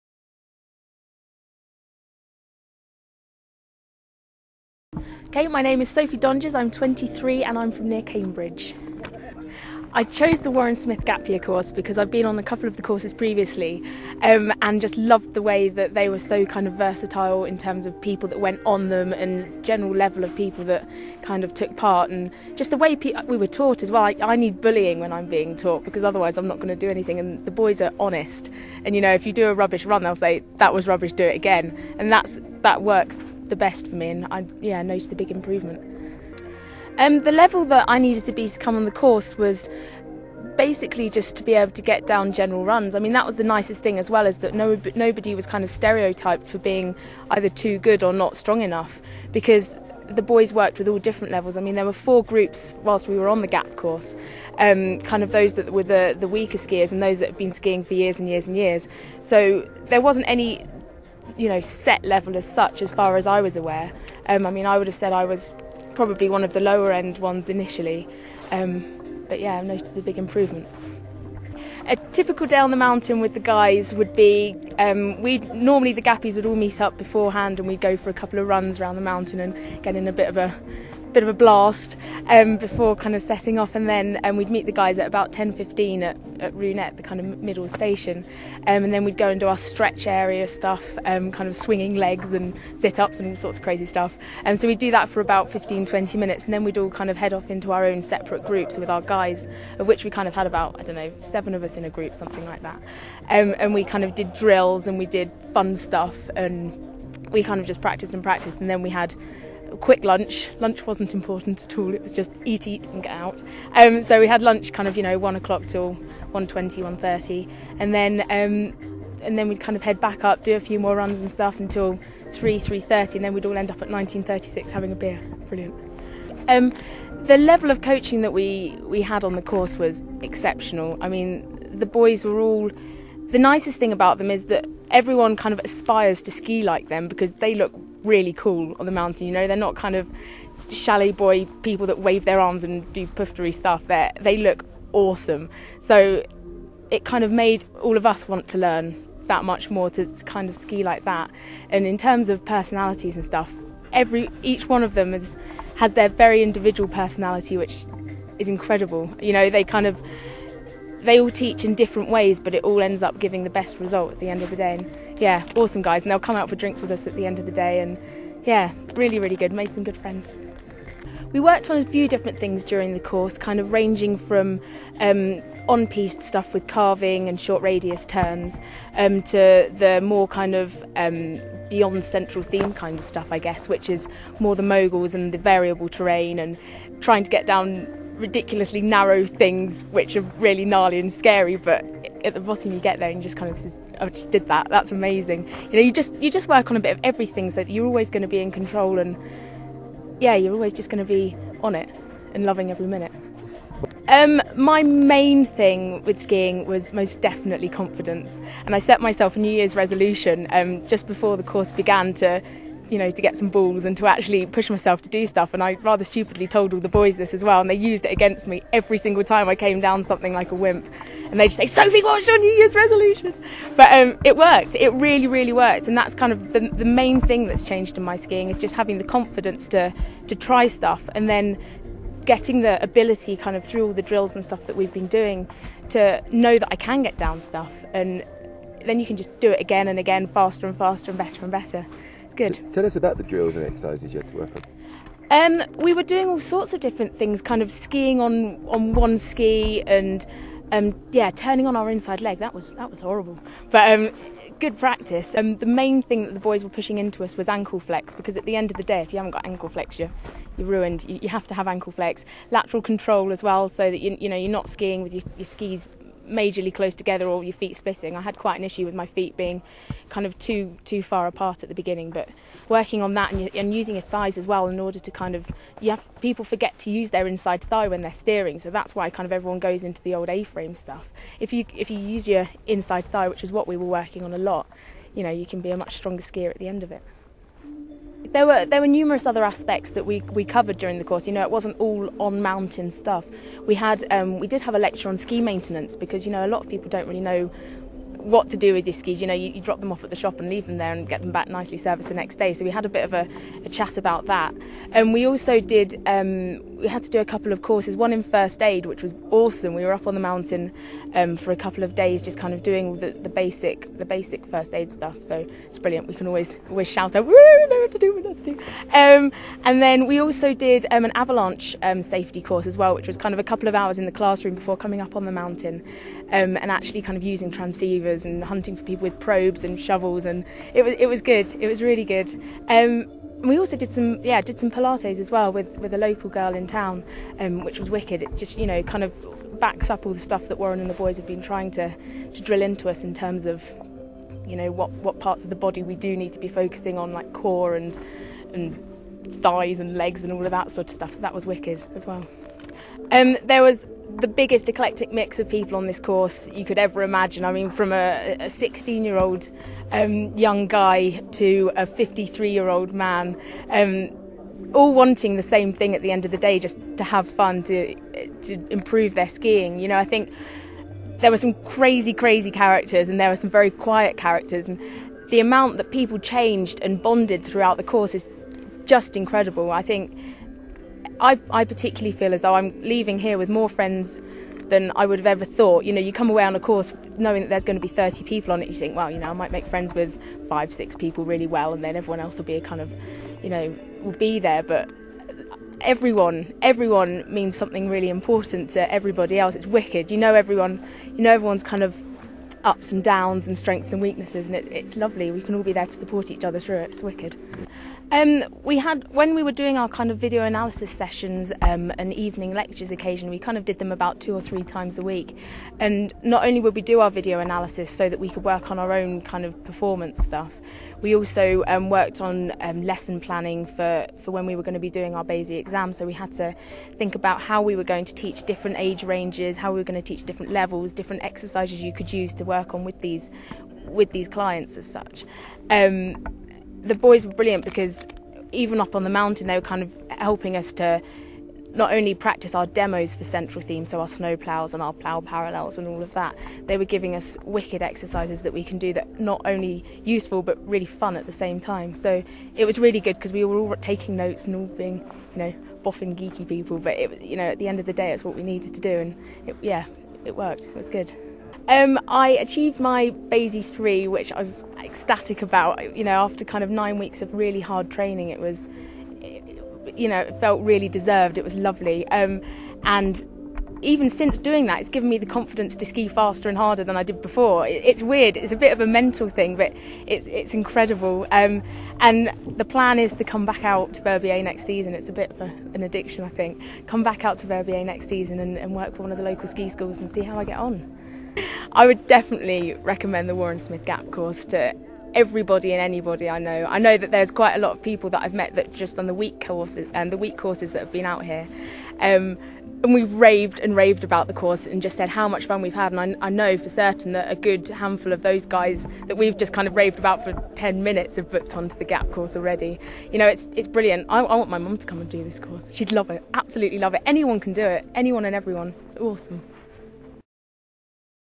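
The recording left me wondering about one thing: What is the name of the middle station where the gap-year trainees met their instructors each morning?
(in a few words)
Ruinettes.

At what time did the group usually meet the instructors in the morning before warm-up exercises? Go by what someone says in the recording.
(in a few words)
10:15.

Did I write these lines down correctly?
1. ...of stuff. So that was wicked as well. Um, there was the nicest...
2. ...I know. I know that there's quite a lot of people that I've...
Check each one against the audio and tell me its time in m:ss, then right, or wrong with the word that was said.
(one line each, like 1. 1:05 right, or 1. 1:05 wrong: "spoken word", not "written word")
1. 5:50 wrong: "biggest", not "nicest"
2. 8:16 right.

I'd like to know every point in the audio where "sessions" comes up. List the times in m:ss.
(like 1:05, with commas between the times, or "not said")
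6:50.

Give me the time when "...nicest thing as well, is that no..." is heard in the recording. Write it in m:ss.
0:43.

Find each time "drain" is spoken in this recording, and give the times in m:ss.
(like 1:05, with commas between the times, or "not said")
not said.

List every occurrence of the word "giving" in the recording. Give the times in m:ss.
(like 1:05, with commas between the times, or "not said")
2:43, 7:26.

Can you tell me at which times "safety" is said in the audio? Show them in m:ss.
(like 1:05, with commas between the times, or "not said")
5:22.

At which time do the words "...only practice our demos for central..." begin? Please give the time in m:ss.
7:21.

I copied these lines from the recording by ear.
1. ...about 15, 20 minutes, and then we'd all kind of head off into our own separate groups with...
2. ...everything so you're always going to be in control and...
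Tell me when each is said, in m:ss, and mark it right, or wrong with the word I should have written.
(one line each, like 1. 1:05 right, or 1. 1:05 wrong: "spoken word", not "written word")
1. 1:35 right
2. 3:17 right.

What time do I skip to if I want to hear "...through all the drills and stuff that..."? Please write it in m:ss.
3:53.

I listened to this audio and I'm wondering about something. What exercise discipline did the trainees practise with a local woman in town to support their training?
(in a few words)
Pilates.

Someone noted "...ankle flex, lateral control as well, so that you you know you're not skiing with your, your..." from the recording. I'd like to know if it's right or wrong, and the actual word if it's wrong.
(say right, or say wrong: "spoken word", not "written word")
right.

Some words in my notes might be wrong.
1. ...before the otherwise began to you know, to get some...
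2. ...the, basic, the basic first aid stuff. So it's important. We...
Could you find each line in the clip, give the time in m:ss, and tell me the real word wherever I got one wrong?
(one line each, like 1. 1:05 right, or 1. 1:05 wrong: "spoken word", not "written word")
1. 3:31 wrong: "course", not "otherwise"
2. 5:13 wrong: "brilliant", not "important".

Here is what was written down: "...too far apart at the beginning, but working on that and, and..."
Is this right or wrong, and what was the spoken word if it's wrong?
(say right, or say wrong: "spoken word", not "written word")
right.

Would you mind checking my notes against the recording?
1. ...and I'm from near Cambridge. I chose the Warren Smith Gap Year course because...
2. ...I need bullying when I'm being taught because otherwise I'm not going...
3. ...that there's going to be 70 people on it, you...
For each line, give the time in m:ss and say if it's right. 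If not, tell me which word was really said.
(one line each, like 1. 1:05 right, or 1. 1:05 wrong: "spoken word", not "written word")
1. 0:07 right
2. 0:24 right
3. 6:27 wrong: "30", not "70".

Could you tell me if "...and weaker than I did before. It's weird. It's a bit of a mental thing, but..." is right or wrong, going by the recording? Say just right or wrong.
wrong.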